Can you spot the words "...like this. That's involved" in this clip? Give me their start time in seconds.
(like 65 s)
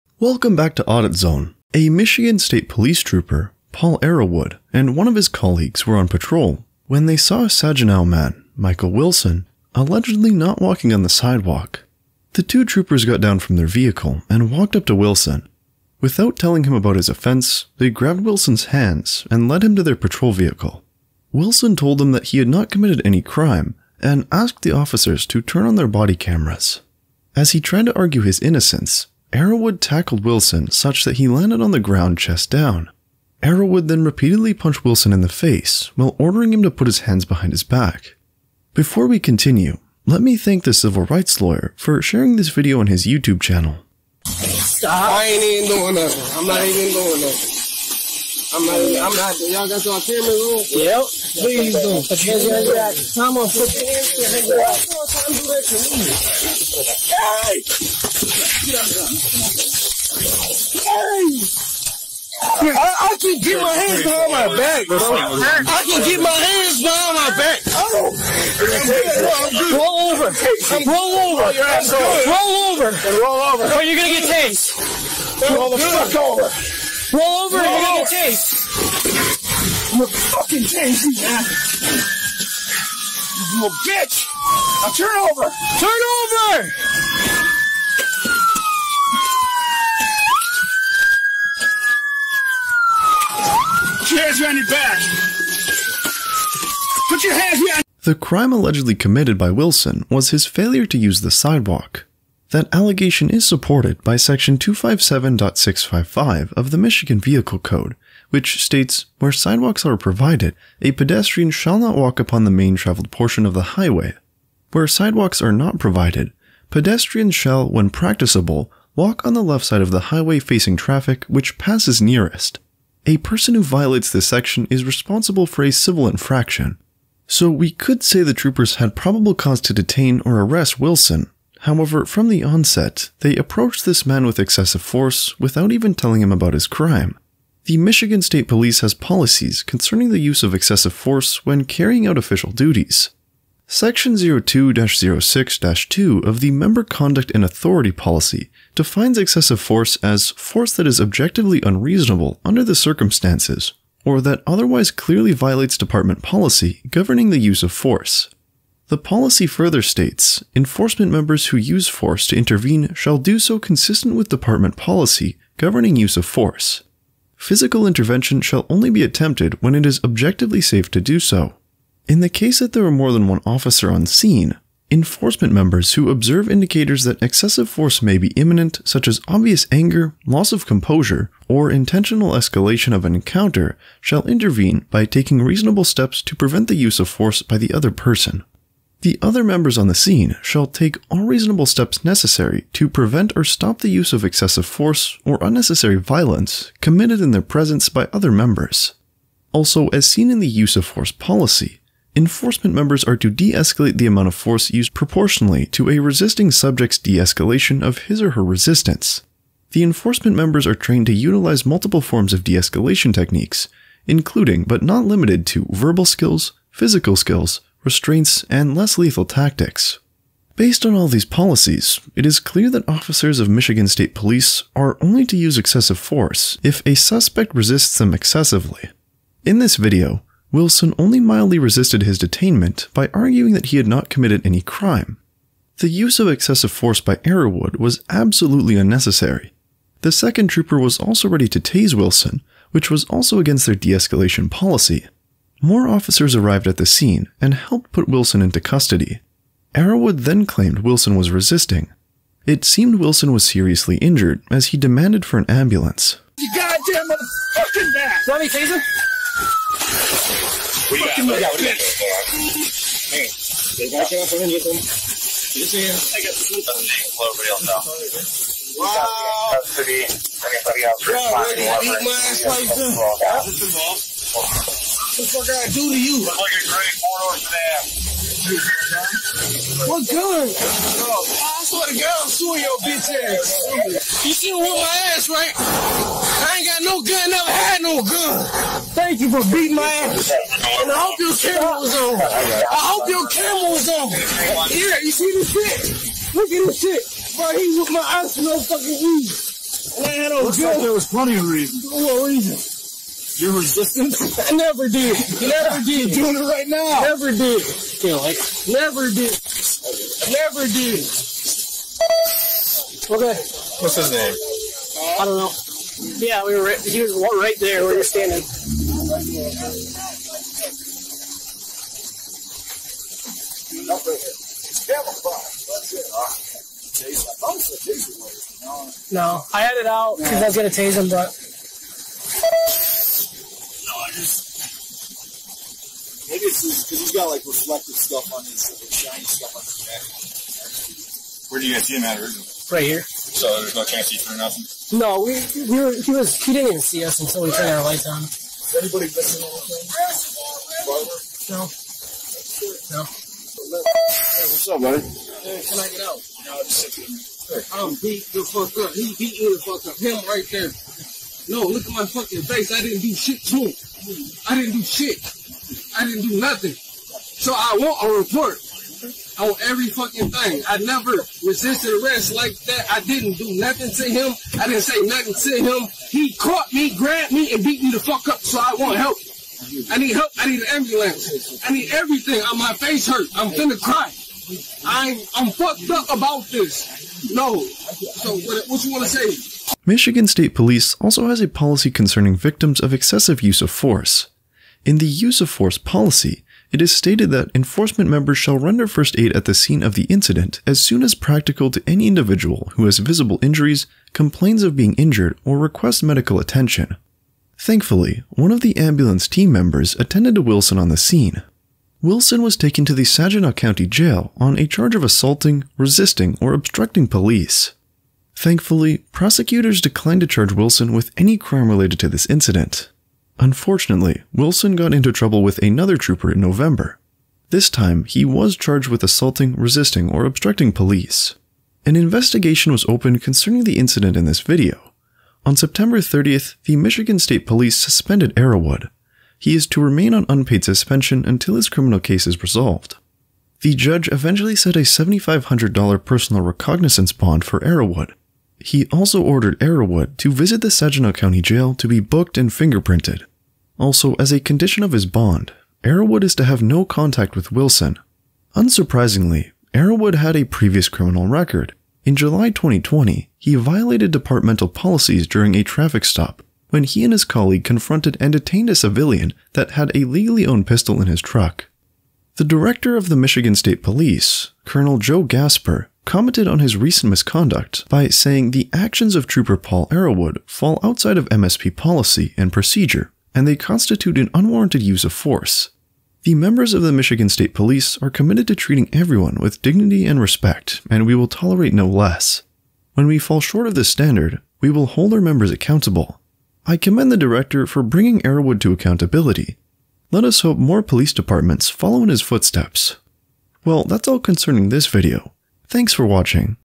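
272 s.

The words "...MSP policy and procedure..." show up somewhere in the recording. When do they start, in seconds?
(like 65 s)
481 s.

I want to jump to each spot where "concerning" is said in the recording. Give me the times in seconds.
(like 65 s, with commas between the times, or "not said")
139 s, 391 s, 433 s, 504 s.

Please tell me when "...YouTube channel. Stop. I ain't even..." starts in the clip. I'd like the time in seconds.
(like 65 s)
43 s.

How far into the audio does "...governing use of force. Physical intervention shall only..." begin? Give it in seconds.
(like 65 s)
165 s.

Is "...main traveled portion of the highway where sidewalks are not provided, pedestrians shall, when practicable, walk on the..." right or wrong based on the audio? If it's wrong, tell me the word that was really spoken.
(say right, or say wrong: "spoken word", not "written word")
right.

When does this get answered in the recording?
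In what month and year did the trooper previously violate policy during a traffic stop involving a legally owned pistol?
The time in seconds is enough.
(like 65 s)
462 s.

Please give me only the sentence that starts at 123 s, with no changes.
A person who violates this section is responsible for a civil infraction.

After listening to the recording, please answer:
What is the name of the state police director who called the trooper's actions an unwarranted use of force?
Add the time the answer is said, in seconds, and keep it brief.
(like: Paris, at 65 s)
Joe Gasper, at 474 s.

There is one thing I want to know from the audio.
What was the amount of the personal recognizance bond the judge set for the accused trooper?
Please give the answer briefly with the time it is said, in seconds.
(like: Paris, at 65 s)
$7,500, at 444 s.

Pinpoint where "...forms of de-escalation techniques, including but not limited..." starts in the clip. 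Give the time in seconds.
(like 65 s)
212 s.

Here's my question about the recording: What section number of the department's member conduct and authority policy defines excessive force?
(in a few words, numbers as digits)
02-06-2.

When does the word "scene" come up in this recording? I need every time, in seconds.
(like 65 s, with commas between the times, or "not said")
174 s, 189 s, 246 s, 399 s, 410 s.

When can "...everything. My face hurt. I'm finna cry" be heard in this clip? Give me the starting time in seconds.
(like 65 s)
381 s.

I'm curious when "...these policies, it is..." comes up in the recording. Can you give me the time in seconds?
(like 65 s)
221 s.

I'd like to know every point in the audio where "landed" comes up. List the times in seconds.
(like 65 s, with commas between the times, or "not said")
31 s.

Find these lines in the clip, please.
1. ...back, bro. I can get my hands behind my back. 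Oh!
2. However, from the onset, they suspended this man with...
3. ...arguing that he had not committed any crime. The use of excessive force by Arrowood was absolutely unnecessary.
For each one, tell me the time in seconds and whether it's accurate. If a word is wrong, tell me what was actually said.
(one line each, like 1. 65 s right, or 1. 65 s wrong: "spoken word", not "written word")
1. 64 s right
2. 131 s wrong: "approached", not "suspended"
3. 233 s right.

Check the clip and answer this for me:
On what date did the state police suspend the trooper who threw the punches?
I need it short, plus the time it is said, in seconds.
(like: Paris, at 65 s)
September 30, at 435 s.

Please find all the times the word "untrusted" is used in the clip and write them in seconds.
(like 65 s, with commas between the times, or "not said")
not said.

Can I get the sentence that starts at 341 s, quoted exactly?
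Where do you guys see him at originally?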